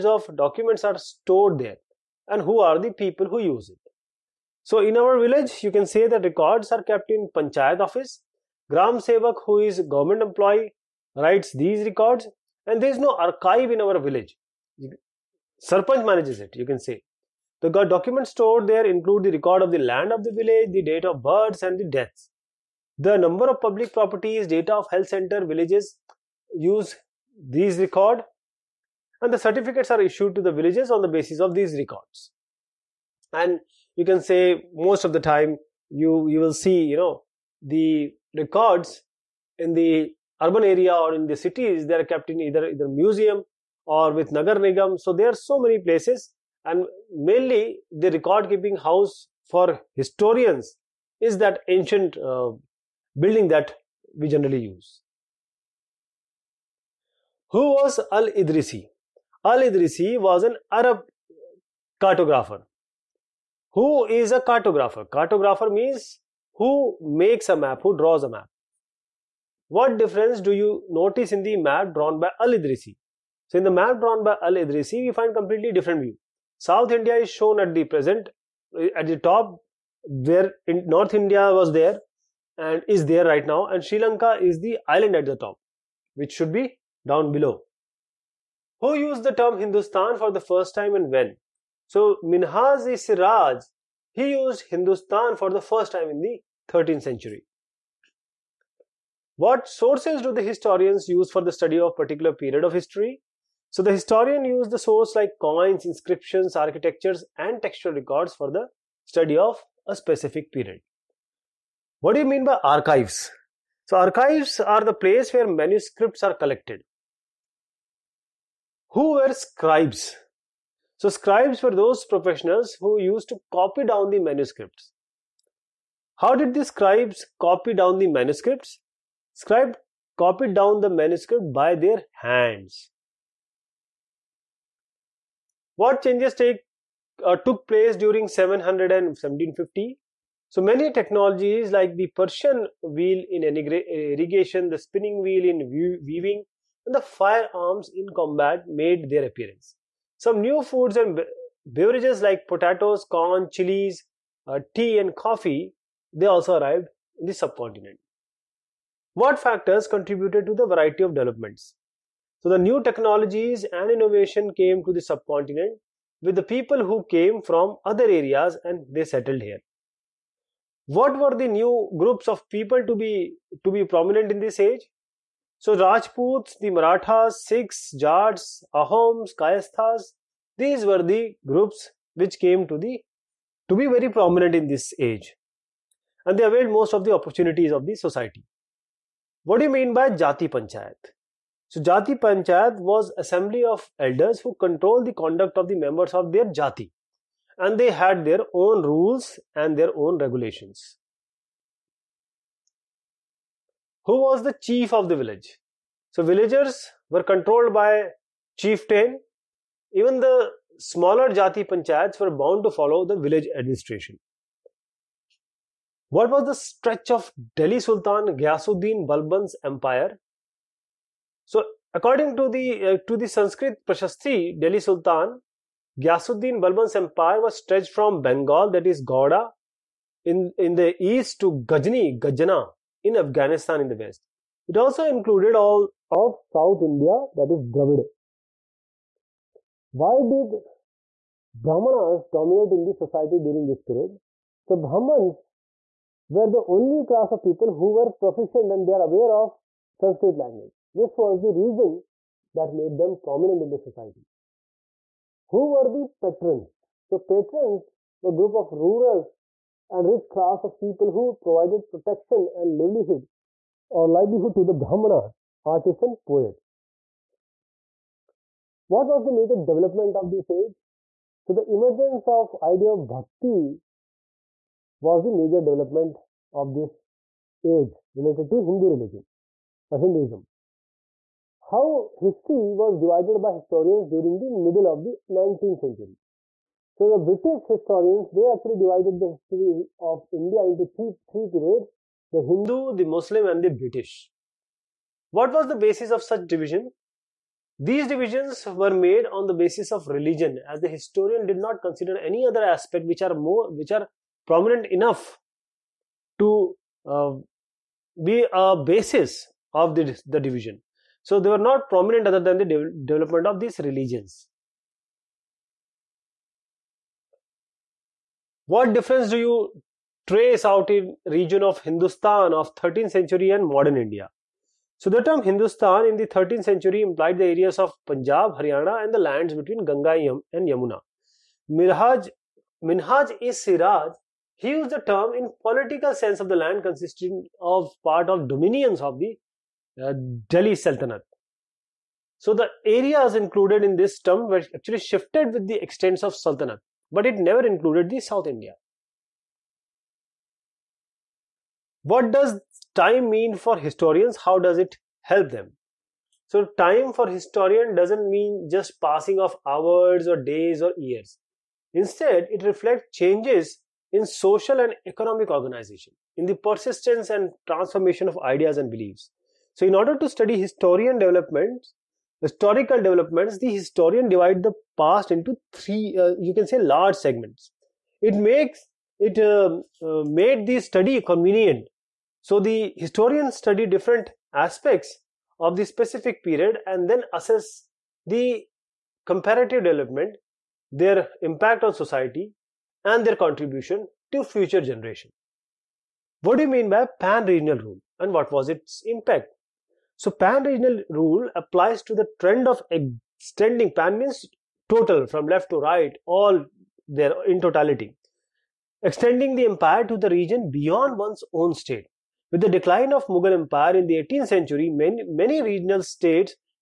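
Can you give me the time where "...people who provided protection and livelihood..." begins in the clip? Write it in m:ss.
4:20.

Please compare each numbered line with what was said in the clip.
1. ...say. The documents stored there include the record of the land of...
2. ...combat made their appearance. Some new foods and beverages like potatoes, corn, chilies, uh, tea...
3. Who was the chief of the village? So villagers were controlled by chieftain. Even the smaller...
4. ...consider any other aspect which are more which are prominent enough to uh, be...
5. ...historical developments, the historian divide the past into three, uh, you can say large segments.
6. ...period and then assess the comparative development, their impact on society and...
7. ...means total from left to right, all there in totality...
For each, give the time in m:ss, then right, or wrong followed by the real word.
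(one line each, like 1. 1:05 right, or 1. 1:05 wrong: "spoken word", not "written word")
1. 0:16 right
2. 2:28 right
3. 3:24 right
4. 5:01 right
5. 6:12 right
6. 6:26 right
7. 6:44 right.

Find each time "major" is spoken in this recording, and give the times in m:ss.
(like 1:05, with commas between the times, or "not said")
4:29, 4:35.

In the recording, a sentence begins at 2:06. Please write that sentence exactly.
How did the scribes copy down the manuscripts?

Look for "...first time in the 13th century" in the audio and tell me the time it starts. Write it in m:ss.
1:35.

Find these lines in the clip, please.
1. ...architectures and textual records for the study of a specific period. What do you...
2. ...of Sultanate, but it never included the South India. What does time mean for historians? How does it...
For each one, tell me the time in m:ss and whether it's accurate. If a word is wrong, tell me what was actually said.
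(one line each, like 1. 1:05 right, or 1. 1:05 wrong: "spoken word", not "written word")
1. 1:46 right
2. 5:46 right.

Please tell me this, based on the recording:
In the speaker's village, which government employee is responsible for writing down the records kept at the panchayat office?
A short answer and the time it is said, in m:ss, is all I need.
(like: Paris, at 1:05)
Gram Sevak, at 0:08.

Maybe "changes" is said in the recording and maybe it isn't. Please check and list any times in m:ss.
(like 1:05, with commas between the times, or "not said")
2:16, 6:03.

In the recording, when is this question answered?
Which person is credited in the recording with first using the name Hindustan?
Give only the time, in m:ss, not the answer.
1:32.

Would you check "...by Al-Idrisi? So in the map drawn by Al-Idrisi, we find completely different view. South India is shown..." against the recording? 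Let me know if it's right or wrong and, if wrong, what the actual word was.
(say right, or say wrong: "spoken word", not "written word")
right.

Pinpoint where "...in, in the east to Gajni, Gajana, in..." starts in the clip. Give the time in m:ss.
3:50.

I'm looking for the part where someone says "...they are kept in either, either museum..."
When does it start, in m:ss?
0:41.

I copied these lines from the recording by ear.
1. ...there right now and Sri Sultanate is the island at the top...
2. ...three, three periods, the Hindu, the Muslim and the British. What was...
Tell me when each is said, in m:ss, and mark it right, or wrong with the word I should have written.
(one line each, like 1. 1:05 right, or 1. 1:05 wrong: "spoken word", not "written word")
1. 1:23 wrong: "Lanka", not "Sultanate"
2. 4:50 right.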